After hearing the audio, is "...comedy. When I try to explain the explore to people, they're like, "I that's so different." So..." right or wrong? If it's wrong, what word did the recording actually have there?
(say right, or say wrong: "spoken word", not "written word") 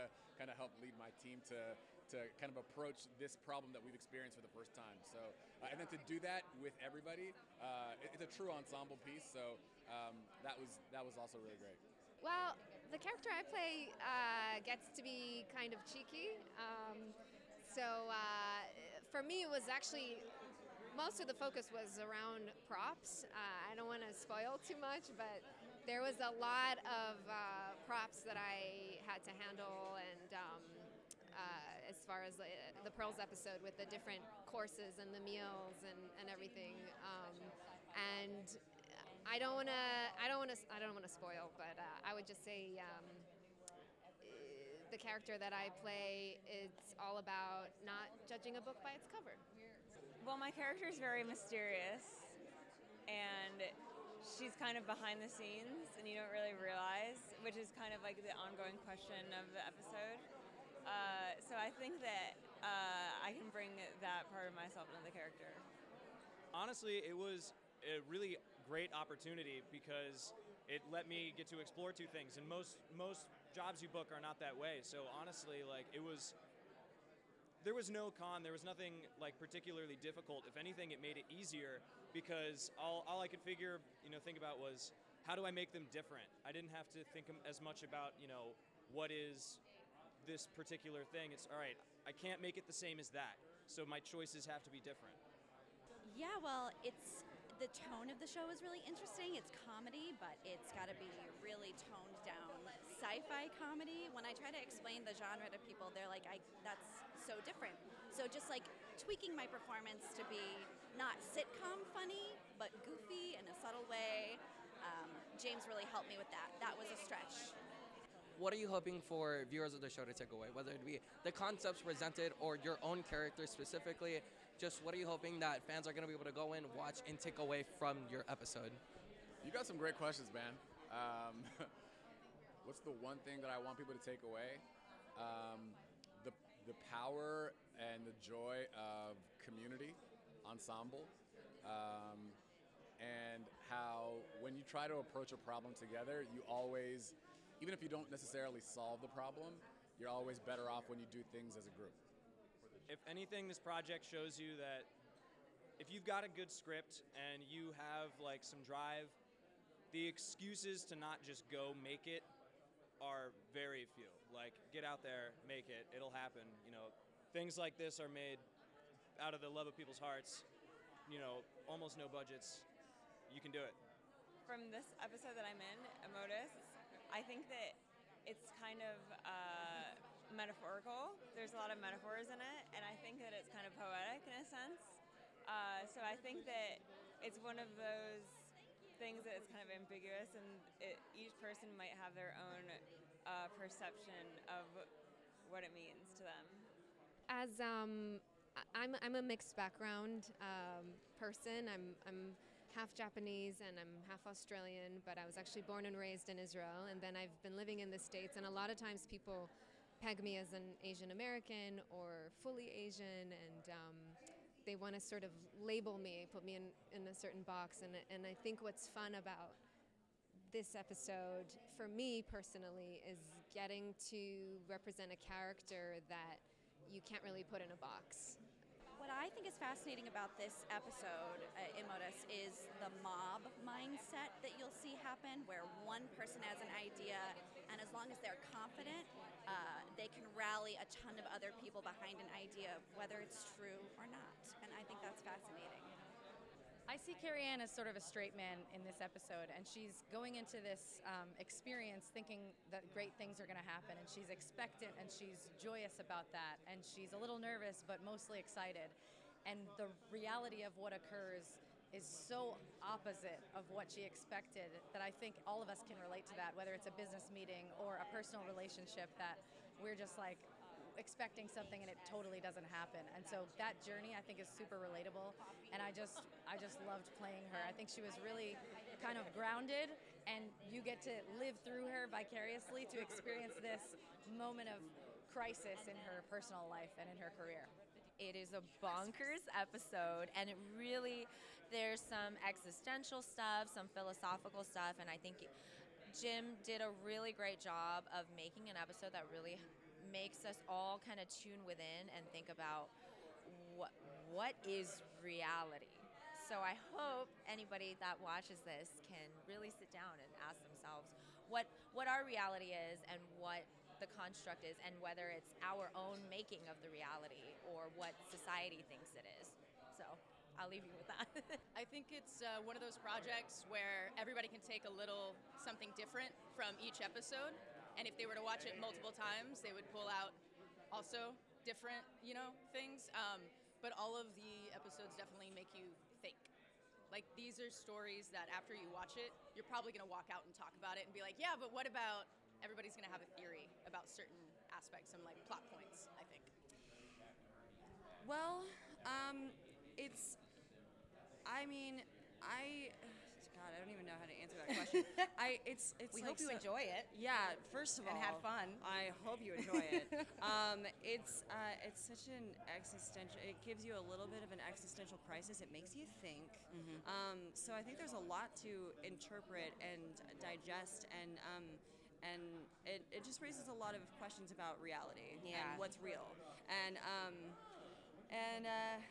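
wrong: "genre", not "explore".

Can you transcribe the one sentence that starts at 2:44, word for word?
Like get out there, make it, it'll happen.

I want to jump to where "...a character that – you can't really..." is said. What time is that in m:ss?
3:45.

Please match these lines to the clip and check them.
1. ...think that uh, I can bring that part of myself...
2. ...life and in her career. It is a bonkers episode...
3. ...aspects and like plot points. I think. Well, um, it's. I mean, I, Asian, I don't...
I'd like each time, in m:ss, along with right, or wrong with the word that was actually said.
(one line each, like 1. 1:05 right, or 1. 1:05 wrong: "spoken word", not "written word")
1. 1:01 right
2. 4:46 right
3. 5:44 wrong: "God", not "Asian".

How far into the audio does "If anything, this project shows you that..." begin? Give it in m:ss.
2:32.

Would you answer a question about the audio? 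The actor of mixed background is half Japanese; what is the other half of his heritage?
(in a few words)
Australian.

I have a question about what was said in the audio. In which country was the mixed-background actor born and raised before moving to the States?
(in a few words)
Israel.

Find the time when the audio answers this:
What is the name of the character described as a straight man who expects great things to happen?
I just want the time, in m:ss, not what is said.
4:07.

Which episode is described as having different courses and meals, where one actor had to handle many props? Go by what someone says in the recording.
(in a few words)
Pearls.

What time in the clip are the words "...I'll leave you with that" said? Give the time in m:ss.
5:20.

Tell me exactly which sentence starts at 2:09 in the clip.
You got some great questions, man.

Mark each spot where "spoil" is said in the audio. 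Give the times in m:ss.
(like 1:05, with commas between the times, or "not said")
0:24, 0:41.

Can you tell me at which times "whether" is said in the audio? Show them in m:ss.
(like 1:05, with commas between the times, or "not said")
2:00, 4:02, 4:26, 5:15.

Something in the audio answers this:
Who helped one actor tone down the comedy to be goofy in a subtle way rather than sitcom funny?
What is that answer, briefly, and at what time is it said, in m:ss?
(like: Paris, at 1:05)
James, at 1:55.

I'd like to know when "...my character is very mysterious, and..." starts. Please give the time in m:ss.
0:50.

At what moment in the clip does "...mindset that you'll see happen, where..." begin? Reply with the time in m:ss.
3:53.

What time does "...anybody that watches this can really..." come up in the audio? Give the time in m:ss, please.
5:07.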